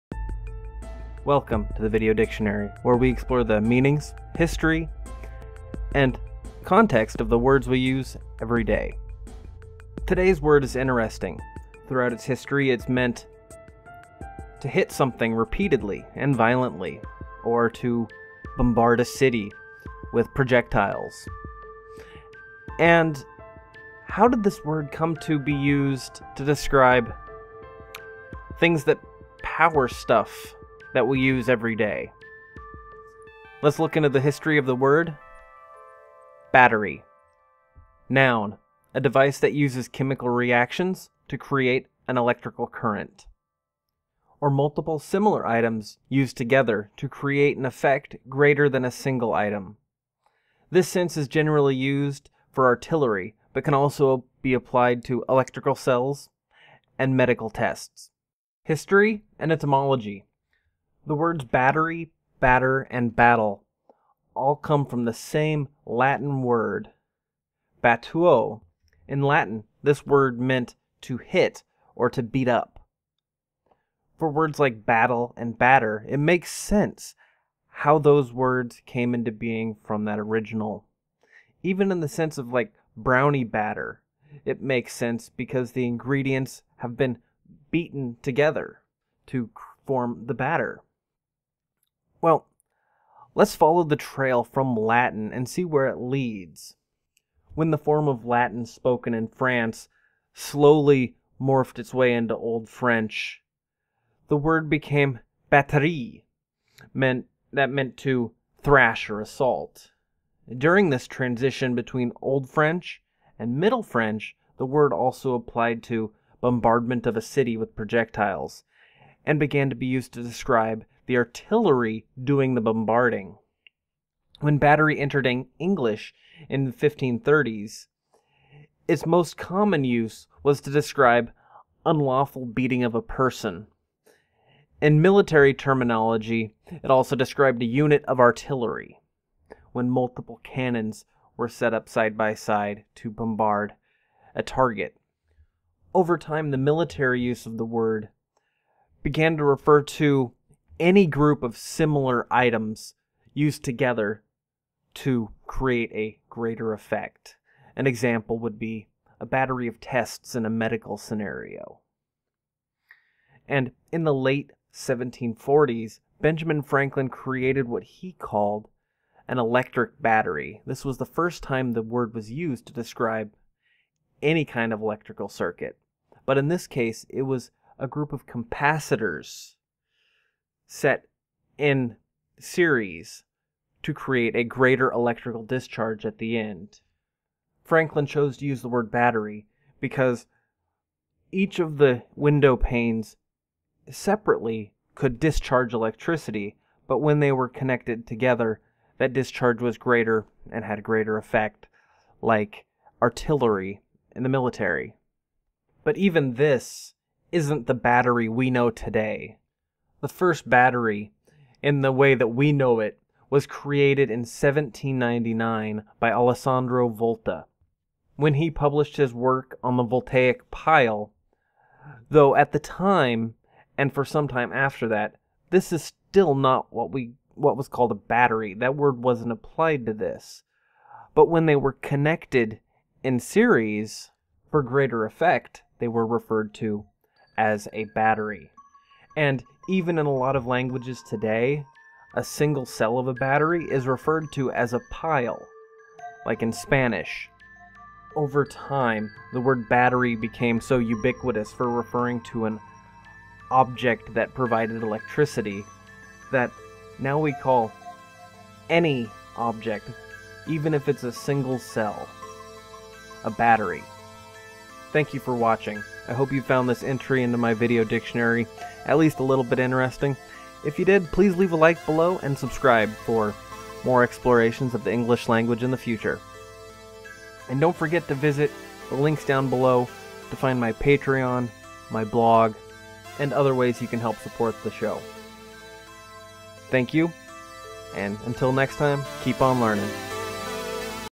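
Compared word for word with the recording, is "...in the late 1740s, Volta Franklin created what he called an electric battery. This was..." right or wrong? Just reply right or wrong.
wrong.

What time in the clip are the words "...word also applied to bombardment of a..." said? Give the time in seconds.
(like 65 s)
114 s.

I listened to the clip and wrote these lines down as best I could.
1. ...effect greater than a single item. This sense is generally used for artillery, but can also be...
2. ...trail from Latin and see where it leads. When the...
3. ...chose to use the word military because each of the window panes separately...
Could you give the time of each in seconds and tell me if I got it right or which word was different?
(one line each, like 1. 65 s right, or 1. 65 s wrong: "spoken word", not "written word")
1. 47 s right
2. 93 s right
3. 188 s wrong: "battery", not "military".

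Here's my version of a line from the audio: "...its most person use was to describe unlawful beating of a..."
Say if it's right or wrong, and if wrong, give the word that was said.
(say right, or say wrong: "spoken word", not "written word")
wrong: "common", not "person".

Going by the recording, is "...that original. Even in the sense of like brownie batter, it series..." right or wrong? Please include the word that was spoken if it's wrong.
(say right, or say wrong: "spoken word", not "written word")
wrong: "makes", not "series".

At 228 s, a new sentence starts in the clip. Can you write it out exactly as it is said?
That word wasn't applied to this.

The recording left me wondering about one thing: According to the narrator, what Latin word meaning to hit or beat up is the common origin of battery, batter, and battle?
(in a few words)
battuo.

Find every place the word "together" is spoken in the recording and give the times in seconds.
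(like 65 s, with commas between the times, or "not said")
46 s, 88 s, 153 s, 198 s.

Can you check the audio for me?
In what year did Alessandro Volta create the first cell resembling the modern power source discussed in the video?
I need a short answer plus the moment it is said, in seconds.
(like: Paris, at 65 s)
1799, at 214 s.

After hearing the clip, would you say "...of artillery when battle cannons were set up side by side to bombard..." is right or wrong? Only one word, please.
wrong.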